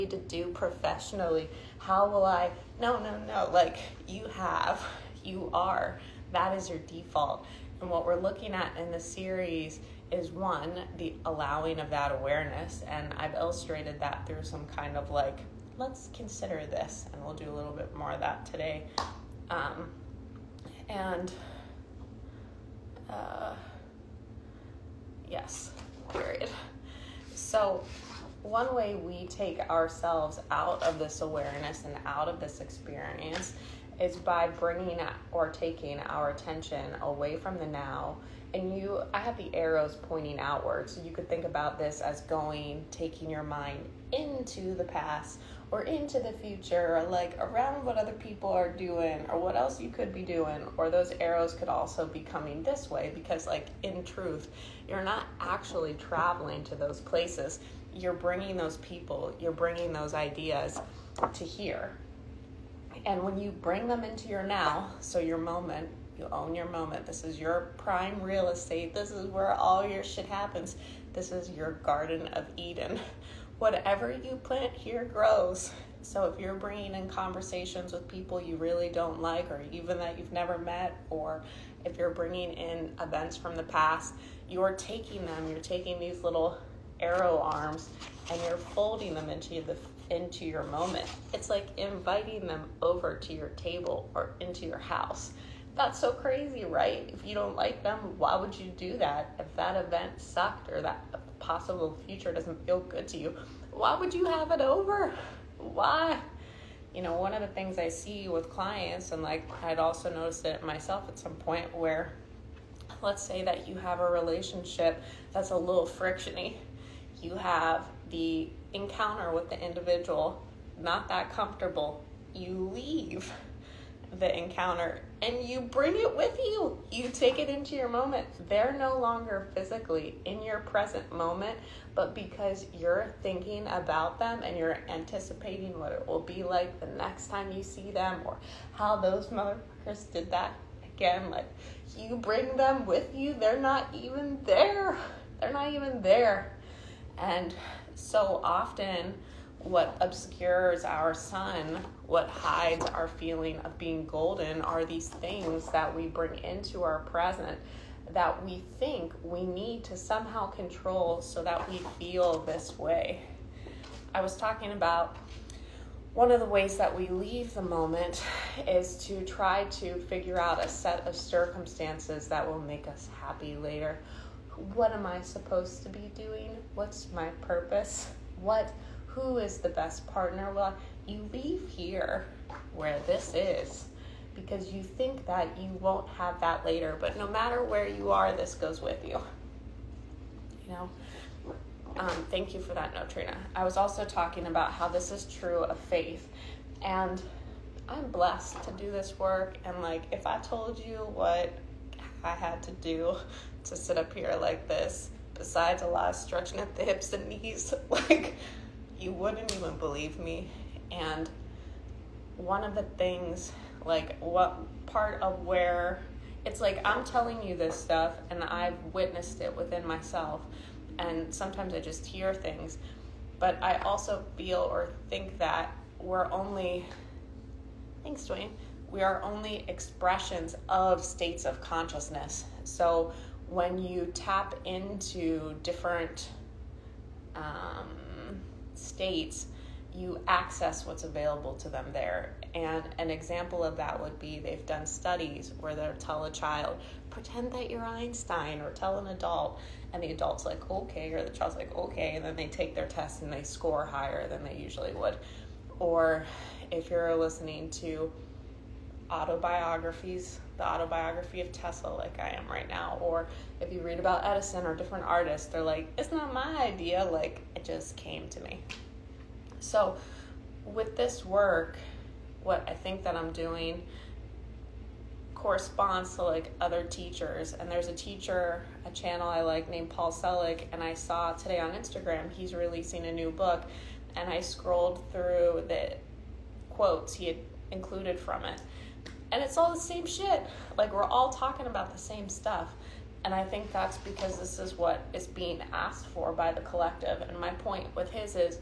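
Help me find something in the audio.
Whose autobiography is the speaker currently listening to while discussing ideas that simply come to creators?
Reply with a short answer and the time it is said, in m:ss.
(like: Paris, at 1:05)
Tesla, at 4:21.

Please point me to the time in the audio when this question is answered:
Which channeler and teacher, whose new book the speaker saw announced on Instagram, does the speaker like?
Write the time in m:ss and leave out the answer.
4:39.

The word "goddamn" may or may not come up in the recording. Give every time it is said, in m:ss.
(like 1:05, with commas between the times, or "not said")
not said.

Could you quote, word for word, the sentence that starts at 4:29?
So, with this work, what I think that I'm doing corresponds to like other teachers.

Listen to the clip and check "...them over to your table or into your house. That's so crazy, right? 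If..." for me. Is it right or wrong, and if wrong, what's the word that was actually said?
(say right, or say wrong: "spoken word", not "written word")
right.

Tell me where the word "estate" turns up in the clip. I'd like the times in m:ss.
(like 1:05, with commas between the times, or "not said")
1:08.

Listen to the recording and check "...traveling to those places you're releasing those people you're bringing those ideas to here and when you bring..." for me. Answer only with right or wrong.
wrong.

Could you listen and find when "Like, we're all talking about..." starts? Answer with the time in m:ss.
4:50.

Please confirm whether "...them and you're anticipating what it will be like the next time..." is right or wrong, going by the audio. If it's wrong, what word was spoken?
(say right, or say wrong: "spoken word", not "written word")
right.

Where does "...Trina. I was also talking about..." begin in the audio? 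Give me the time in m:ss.
3:13.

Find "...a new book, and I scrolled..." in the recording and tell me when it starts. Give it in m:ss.
4:43.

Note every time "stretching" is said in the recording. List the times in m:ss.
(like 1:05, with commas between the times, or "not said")
3:26.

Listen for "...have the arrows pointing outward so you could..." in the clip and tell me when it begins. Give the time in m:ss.
0:39.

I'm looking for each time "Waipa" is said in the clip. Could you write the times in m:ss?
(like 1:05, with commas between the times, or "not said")
not said.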